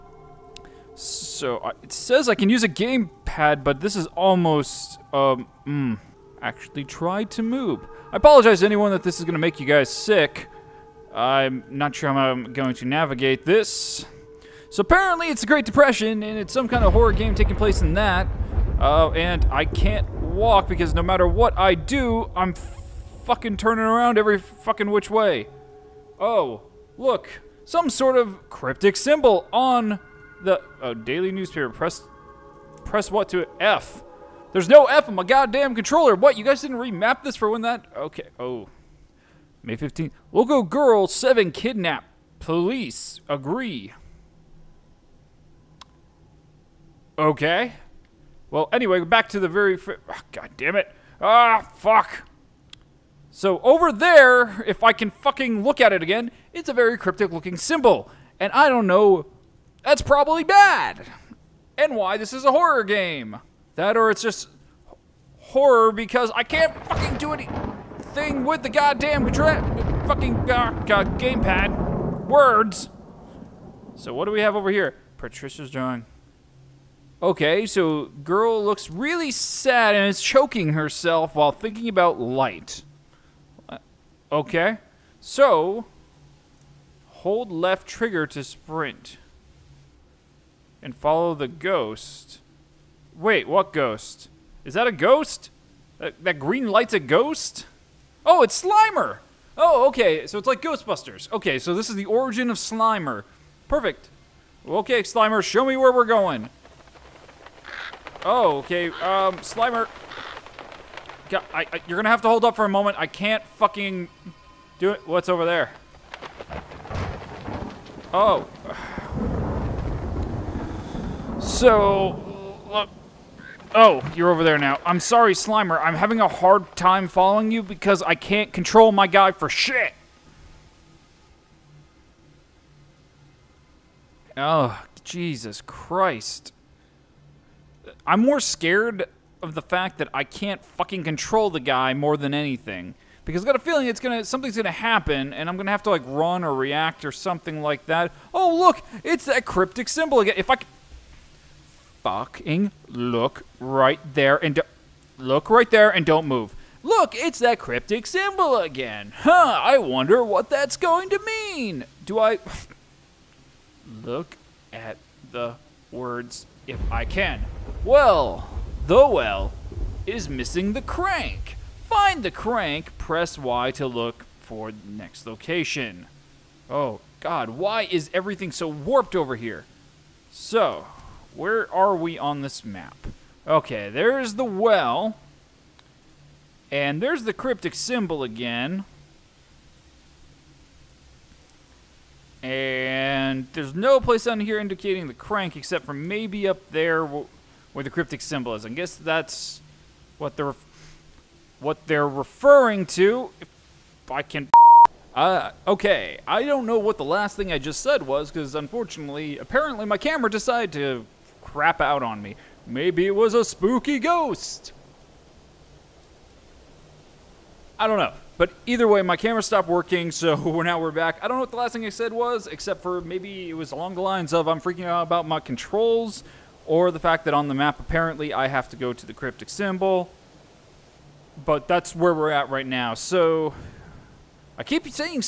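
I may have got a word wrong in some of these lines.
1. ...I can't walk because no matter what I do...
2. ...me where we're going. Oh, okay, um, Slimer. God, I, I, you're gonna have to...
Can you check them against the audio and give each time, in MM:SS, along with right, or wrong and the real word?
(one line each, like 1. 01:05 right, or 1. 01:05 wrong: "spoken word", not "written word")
1. 00:19 right
2. 01:45 right.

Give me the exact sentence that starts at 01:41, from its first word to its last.
Okay, so this is the origin of Slimer.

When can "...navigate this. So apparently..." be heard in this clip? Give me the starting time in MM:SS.
00:12.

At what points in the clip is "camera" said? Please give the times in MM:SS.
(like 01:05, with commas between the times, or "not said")
03:29, 03:39.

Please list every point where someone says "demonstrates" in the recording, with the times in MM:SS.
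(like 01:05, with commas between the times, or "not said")
not said.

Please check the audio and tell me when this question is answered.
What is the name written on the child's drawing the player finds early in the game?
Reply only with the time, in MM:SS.
01:15.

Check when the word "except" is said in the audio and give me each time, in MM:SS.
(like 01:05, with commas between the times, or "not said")
03:15, 03:42.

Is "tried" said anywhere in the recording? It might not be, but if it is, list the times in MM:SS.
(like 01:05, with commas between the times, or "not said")
00:06.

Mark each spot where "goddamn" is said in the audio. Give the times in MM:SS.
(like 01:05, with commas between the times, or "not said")
00:35, 01:08.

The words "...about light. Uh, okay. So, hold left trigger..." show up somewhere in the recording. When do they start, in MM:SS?
01:21.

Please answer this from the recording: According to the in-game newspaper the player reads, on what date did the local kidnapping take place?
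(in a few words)
May 15th.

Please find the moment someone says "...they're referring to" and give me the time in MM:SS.
03:21.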